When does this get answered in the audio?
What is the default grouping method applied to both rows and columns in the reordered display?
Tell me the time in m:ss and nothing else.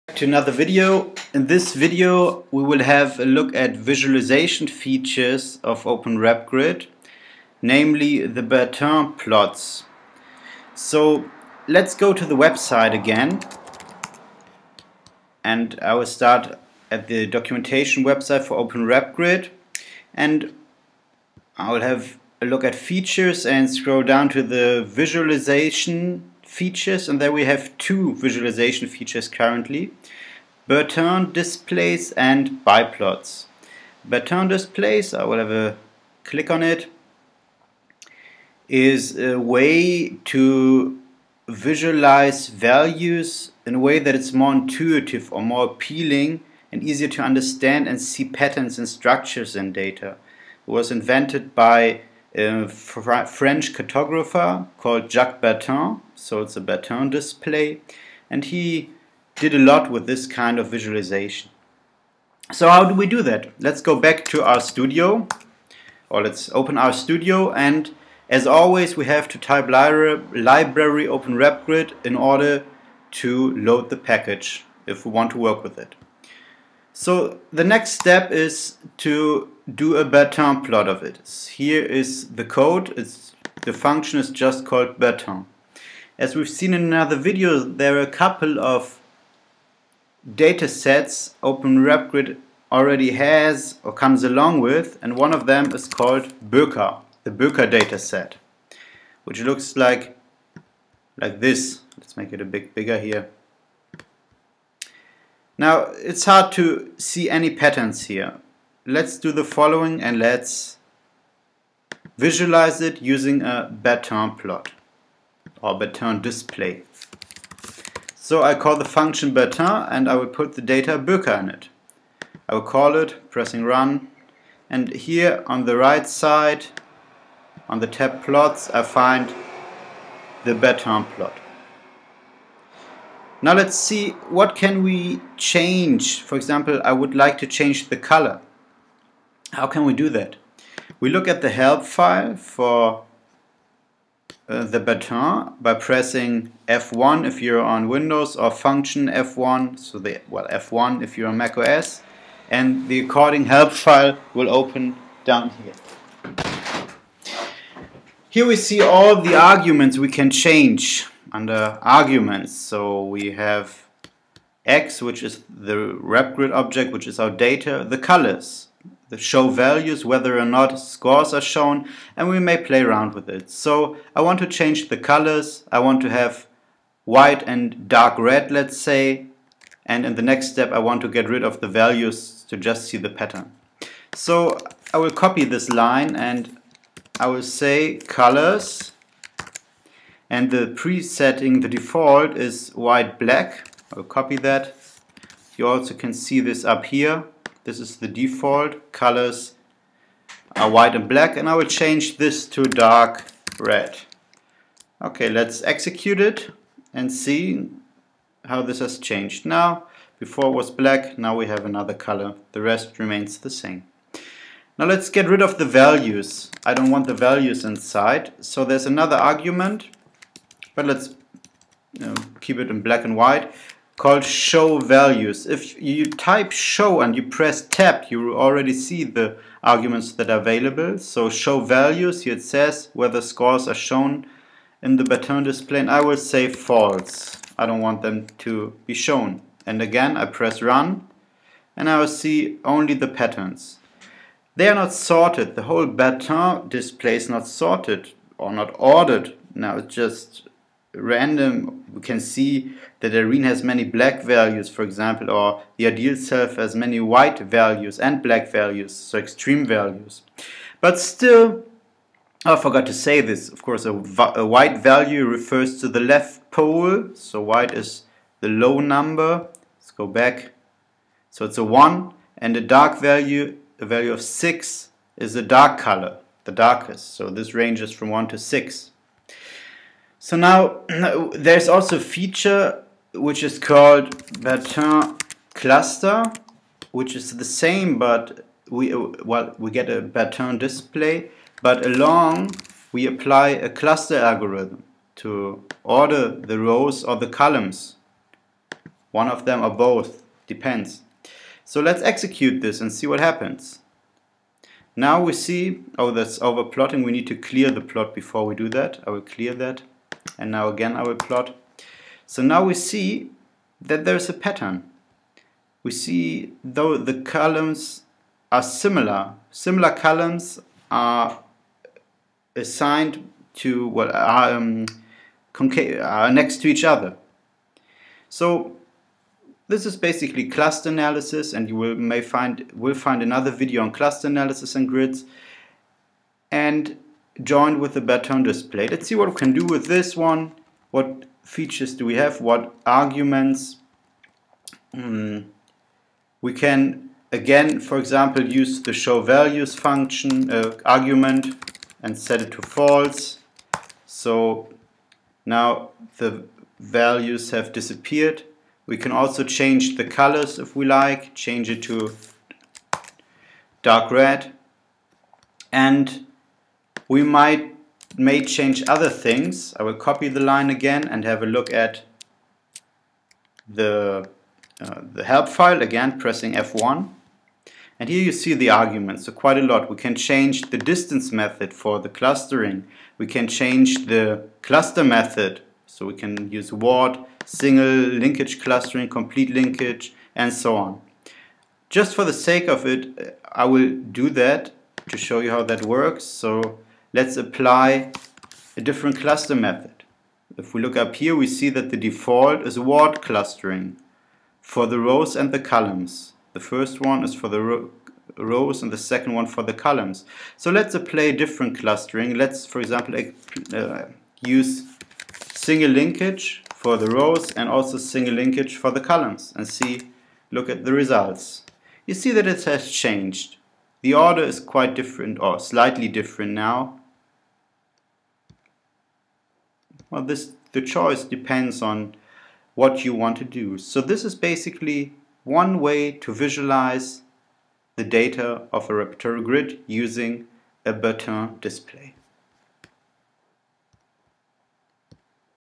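6:42.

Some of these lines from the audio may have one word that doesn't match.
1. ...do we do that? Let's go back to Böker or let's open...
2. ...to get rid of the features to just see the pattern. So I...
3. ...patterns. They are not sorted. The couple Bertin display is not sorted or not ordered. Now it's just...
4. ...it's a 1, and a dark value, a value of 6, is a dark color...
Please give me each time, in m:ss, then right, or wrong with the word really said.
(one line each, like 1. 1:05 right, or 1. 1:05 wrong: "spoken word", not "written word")
1. 1:02 wrong: "RStudio", not "Böker"
2. 3:01 wrong: "values", not "features"
3. 4:03 wrong: "whole", not "couple"
4. 4:31 right.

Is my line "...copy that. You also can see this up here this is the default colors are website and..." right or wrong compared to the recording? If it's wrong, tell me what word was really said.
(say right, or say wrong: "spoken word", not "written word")
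wrong: "white", not "website".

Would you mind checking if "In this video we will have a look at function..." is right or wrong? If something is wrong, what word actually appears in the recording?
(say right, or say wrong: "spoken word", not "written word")
wrong: "visualization", not "function".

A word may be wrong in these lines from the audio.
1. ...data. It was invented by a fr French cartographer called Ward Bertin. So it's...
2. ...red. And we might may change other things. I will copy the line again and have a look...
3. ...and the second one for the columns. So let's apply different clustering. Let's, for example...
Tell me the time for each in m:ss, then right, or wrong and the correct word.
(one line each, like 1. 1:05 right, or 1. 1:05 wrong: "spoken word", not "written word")
1. 0:49 wrong: "Jacques", not "Ward"
2. 6:04 right
3. 6:48 right.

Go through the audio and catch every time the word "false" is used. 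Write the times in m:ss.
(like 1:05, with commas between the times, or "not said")
3:56, 5:52.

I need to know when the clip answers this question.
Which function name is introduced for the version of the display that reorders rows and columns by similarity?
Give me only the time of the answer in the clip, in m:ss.
4:44.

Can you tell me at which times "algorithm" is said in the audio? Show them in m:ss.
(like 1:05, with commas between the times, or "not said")
4:54.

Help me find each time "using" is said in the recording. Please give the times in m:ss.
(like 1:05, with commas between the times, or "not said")
1:53, 7:19.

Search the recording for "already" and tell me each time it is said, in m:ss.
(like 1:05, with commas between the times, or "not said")
1:32, 3:48.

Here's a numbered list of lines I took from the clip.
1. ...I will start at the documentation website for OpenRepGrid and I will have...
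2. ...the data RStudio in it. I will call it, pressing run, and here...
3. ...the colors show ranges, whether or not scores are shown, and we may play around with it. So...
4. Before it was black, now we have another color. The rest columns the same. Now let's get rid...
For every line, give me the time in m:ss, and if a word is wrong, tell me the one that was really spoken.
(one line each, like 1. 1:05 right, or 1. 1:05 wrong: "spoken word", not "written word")
1. 0:15 right
2. 2:00 wrong: "Böker", not "RStudio"
3. 2:47 wrong: "values", not "ranges"
4. 3:30 wrong: "remains", not "columns".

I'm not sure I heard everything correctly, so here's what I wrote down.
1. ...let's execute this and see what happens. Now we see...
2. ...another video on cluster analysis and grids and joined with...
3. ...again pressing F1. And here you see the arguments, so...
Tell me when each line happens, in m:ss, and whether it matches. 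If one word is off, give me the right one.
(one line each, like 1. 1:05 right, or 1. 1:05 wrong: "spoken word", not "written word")
1. 5:01 right
2. 5:33 right
3. 6:15 right.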